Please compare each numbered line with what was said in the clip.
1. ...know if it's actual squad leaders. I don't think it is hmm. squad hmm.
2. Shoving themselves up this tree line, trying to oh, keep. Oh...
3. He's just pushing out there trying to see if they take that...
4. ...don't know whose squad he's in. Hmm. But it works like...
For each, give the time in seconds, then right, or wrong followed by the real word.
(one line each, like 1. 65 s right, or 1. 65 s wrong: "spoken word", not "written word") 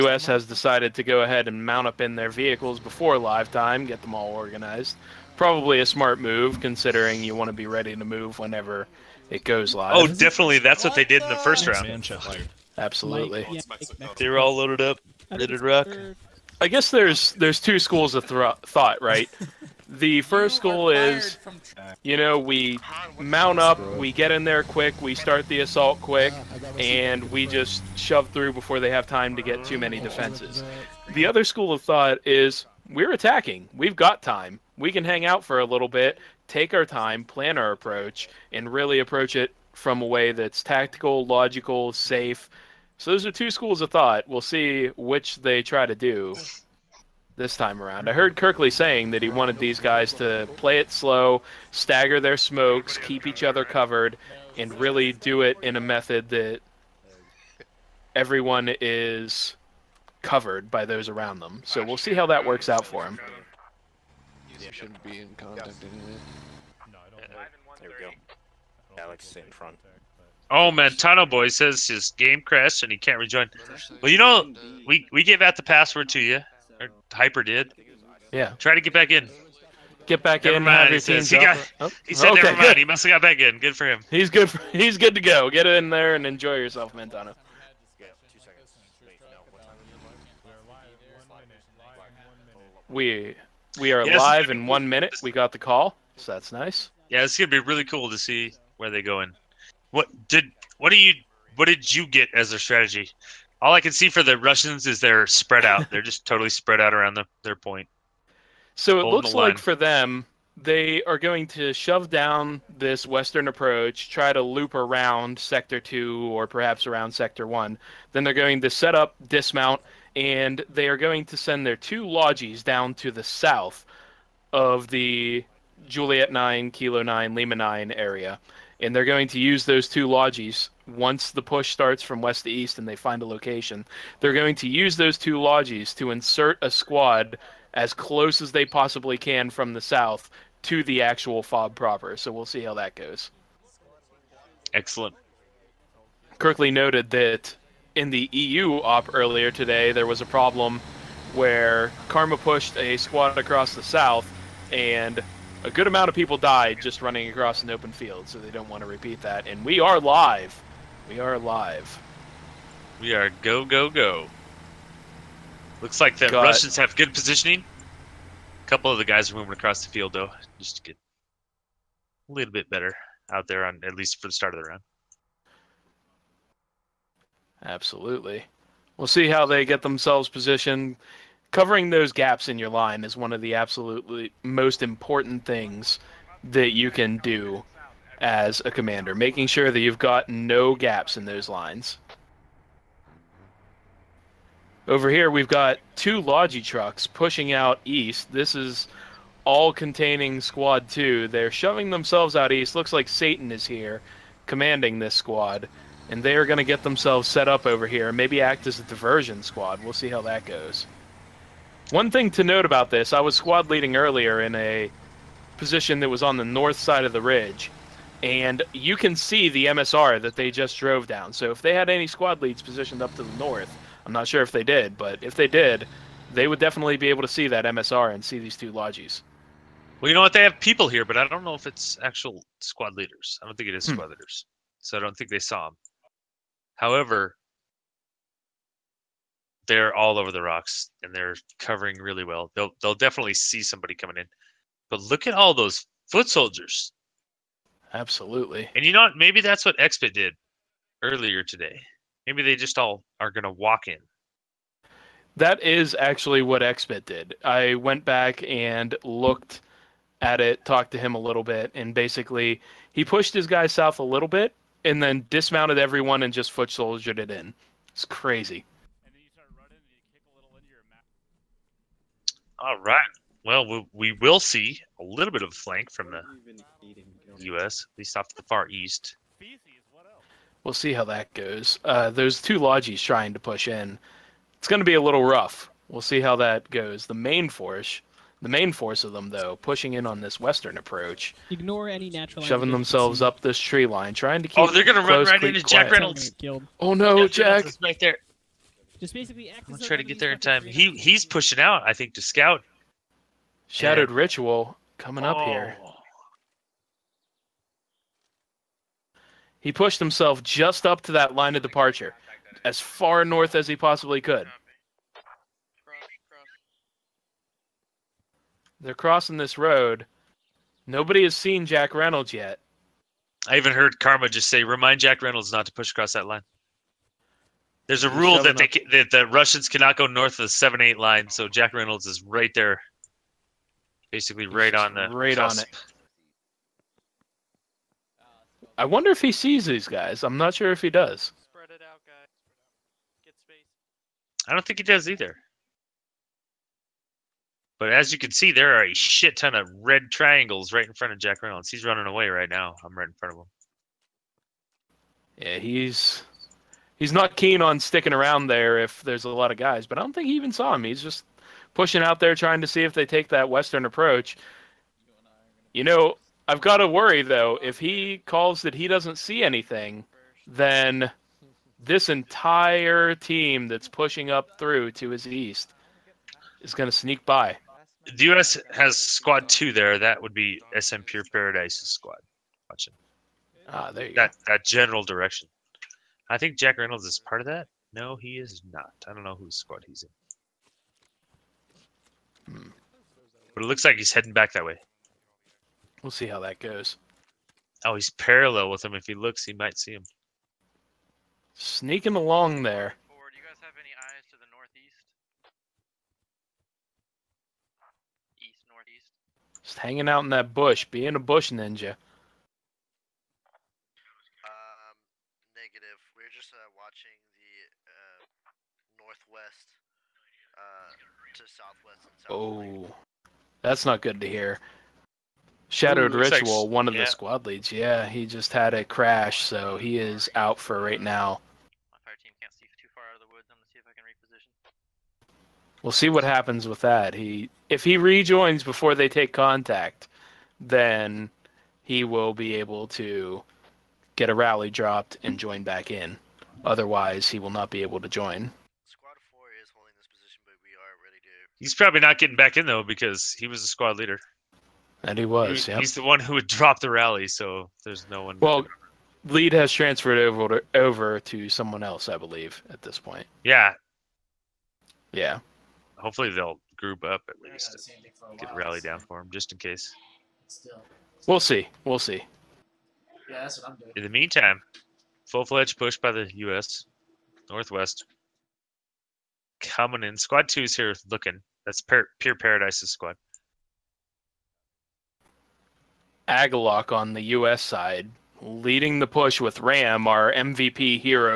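1. 231 s right
2. 292 s right
3. 360 s right
4. 389 s wrong: "looks", not "works".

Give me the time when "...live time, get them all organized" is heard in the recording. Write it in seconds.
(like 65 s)
3 s.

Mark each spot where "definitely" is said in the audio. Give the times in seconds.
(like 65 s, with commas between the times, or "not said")
10 s, 226 s, 242 s.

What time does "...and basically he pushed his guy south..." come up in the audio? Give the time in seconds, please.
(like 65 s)
261 s.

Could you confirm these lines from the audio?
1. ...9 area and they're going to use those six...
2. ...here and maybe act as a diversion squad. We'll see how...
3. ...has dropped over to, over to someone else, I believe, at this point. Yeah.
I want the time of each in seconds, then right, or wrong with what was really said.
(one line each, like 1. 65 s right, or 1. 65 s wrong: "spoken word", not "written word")
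1. 127 s wrong: "two", not "six"
2. 207 s right
3. 459 s wrong: "transferred", not "dropped".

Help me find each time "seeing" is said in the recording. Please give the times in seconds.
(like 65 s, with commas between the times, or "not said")
not said.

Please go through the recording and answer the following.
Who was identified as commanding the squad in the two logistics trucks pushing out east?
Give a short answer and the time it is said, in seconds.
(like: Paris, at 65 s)
Satan, at 203 s.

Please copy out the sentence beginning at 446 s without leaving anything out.
Otherwise, he will not be able to join.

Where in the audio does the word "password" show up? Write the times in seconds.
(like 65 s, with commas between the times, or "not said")
75 s.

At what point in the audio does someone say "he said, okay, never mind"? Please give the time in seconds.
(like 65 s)
82 s.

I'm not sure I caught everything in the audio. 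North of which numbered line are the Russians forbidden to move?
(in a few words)
seven eight line.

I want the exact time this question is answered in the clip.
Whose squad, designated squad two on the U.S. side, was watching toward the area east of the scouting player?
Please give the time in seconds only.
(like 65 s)
380 s.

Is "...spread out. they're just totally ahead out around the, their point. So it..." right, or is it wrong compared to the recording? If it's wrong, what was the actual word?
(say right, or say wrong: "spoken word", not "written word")
wrong: "spread", not "ahead".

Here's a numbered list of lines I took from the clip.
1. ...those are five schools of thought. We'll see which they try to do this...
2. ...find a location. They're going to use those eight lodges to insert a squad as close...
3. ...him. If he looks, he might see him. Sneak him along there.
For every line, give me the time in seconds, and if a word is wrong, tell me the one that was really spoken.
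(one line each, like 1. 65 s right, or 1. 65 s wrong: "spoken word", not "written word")
1. 43 s wrong: "two", not "five"
2. 132 s wrong: "two", not "eight"
3. 398 s right.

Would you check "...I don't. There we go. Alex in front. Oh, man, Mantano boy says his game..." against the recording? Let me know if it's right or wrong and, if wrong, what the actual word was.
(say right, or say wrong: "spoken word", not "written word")
right.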